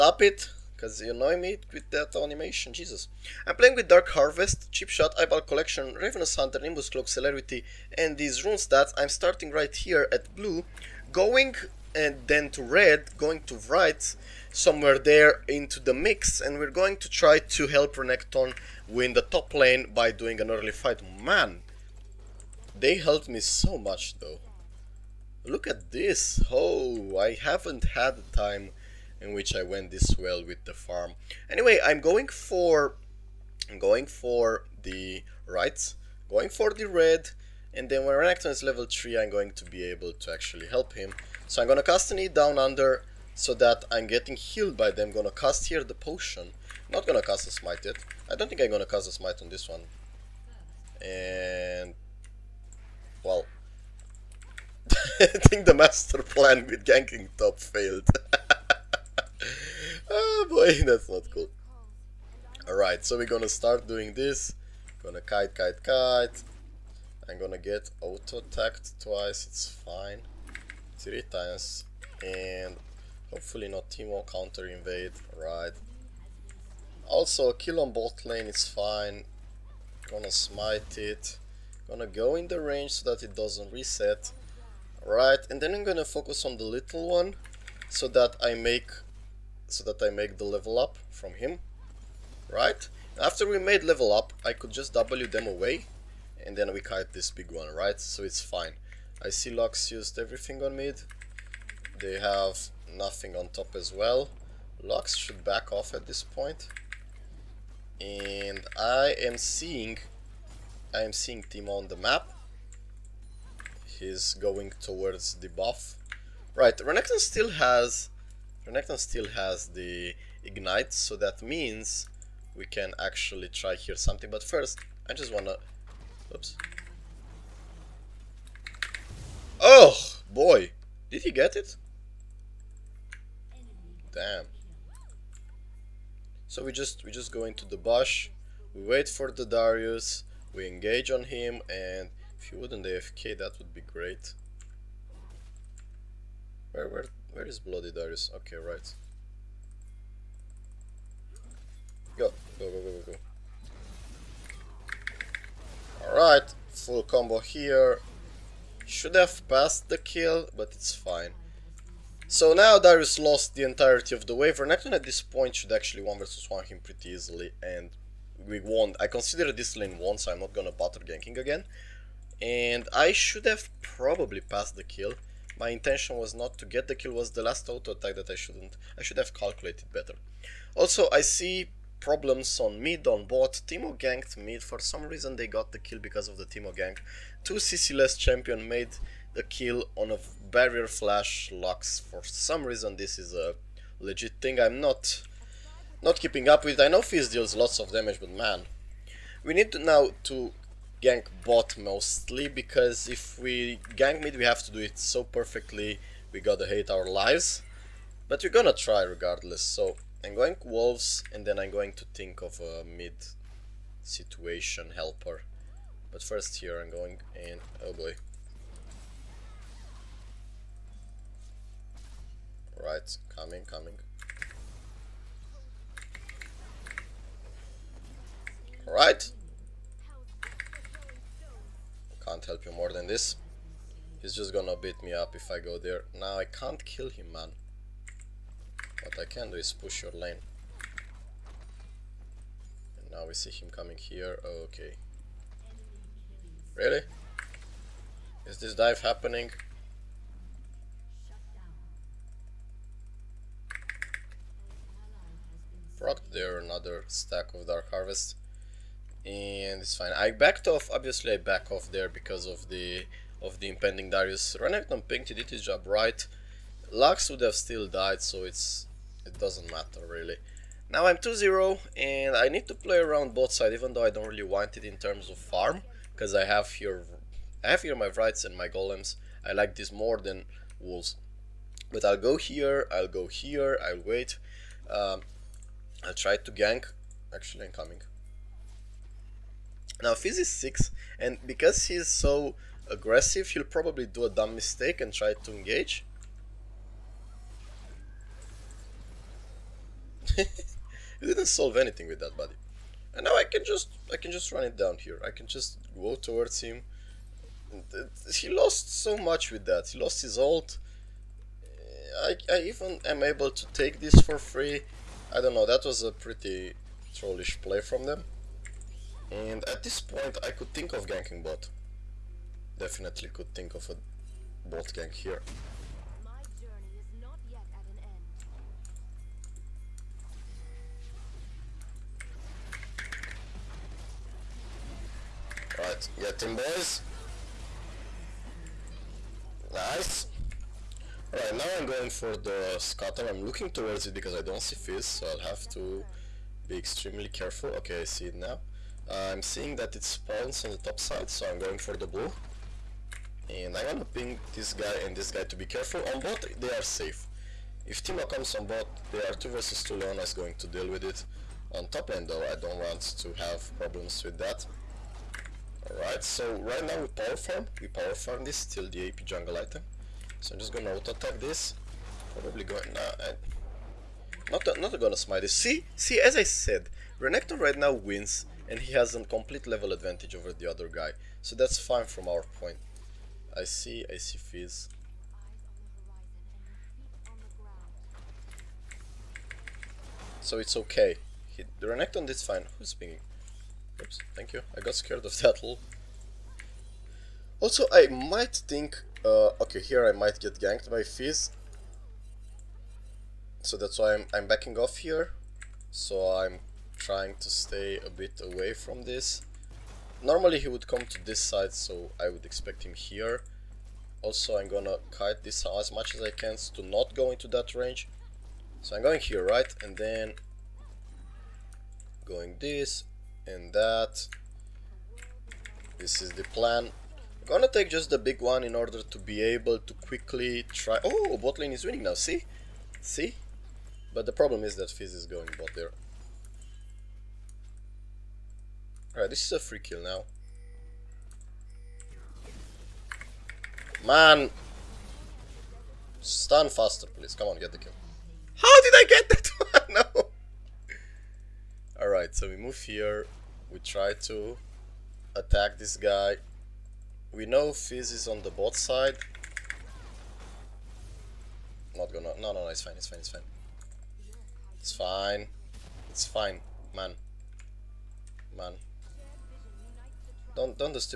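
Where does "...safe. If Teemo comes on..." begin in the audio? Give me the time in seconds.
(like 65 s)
356 s.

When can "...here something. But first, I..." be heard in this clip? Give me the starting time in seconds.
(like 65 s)
123 s.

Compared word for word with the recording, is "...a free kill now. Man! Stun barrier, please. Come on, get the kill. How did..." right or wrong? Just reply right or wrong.
wrong.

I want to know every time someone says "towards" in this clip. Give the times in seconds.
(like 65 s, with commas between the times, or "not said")
114 s, 306 s, 343 s.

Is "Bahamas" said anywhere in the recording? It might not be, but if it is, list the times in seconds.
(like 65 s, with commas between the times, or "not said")
not said.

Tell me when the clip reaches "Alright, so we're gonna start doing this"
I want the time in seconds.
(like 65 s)
62 s.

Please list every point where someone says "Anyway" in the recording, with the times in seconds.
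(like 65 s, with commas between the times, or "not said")
31 s.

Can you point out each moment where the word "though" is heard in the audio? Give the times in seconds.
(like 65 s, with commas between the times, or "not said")
24 s, 273 s, 362 s.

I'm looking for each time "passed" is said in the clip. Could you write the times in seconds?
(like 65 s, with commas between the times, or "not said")
159 s, 174 s.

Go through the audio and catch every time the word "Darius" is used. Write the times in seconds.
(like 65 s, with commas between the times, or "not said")
139 s, 147 s, 162 s, 264 s.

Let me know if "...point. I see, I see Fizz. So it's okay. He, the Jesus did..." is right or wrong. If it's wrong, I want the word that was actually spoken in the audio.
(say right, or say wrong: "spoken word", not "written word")
wrong: "Renekton", not "Jesus".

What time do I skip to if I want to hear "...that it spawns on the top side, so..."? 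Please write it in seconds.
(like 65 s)
349 s.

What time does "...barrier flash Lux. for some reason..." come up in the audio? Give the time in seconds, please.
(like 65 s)
190 s.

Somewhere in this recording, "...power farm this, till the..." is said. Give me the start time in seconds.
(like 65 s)
367 s.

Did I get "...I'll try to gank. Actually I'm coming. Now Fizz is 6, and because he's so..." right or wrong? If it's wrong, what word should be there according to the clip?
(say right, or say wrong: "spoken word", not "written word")
right.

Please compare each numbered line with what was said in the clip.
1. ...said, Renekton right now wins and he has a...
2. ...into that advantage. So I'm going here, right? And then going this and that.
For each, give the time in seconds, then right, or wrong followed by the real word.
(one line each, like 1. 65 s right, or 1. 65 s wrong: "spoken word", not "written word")
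1. 376 s right
2. 417 s wrong: "range", not "advantage".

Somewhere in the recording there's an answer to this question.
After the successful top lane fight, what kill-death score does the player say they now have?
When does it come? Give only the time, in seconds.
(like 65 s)
271 s.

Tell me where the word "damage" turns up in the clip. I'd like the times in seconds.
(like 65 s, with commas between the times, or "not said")
197 s.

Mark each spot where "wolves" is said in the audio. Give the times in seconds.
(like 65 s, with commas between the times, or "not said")
210 s, 280 s.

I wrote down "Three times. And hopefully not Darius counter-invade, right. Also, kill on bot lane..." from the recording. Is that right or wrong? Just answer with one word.
wrong.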